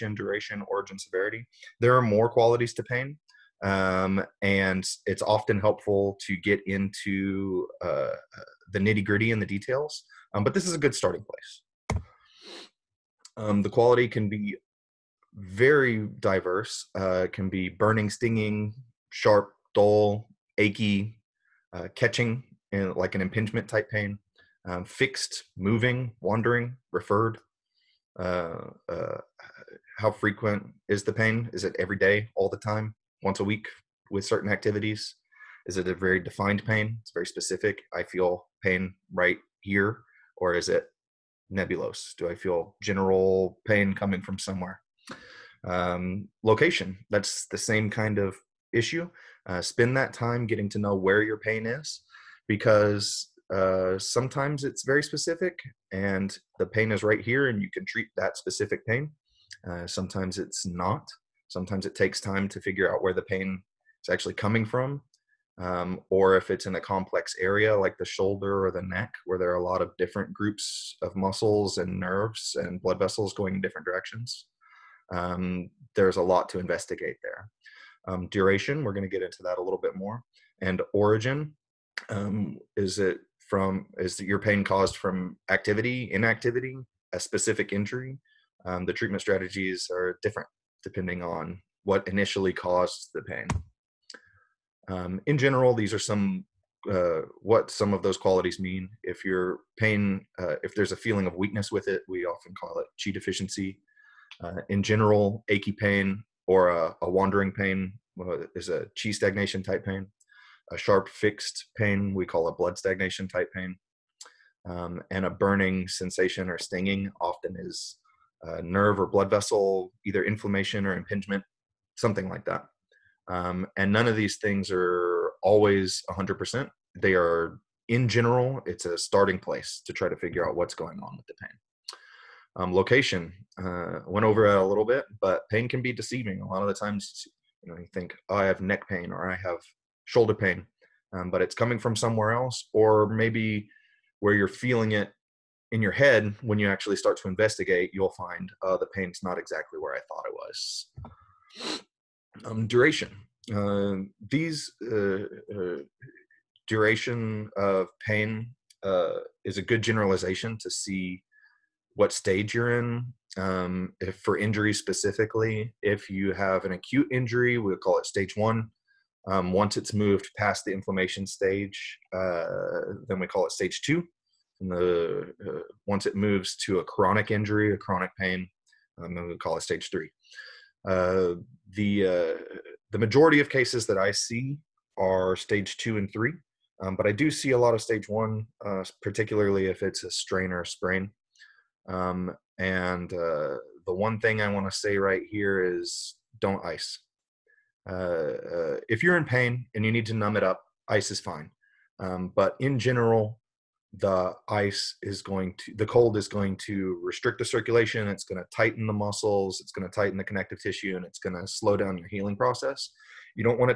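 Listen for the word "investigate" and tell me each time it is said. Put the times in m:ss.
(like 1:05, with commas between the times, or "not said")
1:16, 2:27.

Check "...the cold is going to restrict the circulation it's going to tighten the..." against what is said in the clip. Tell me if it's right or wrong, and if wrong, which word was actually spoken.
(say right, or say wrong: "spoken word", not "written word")
right.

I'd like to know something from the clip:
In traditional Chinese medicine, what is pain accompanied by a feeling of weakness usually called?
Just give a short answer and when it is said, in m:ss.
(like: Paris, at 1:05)
Chi deficiency, at 1:43.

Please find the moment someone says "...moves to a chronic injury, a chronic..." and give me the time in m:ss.
2:56.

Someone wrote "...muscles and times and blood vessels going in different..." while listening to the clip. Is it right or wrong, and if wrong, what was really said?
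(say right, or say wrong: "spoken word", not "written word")
wrong: "nerves", not "times".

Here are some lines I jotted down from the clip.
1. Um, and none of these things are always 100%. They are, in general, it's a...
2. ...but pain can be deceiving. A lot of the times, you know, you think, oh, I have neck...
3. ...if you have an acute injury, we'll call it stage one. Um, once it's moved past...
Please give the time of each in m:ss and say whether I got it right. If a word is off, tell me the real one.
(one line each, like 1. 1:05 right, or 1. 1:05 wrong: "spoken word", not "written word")
1. 2:03 right
2. 2:15 right
3. 2:45 right.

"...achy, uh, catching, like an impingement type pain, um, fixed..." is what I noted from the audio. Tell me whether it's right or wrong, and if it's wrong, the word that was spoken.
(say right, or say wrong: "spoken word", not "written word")
right.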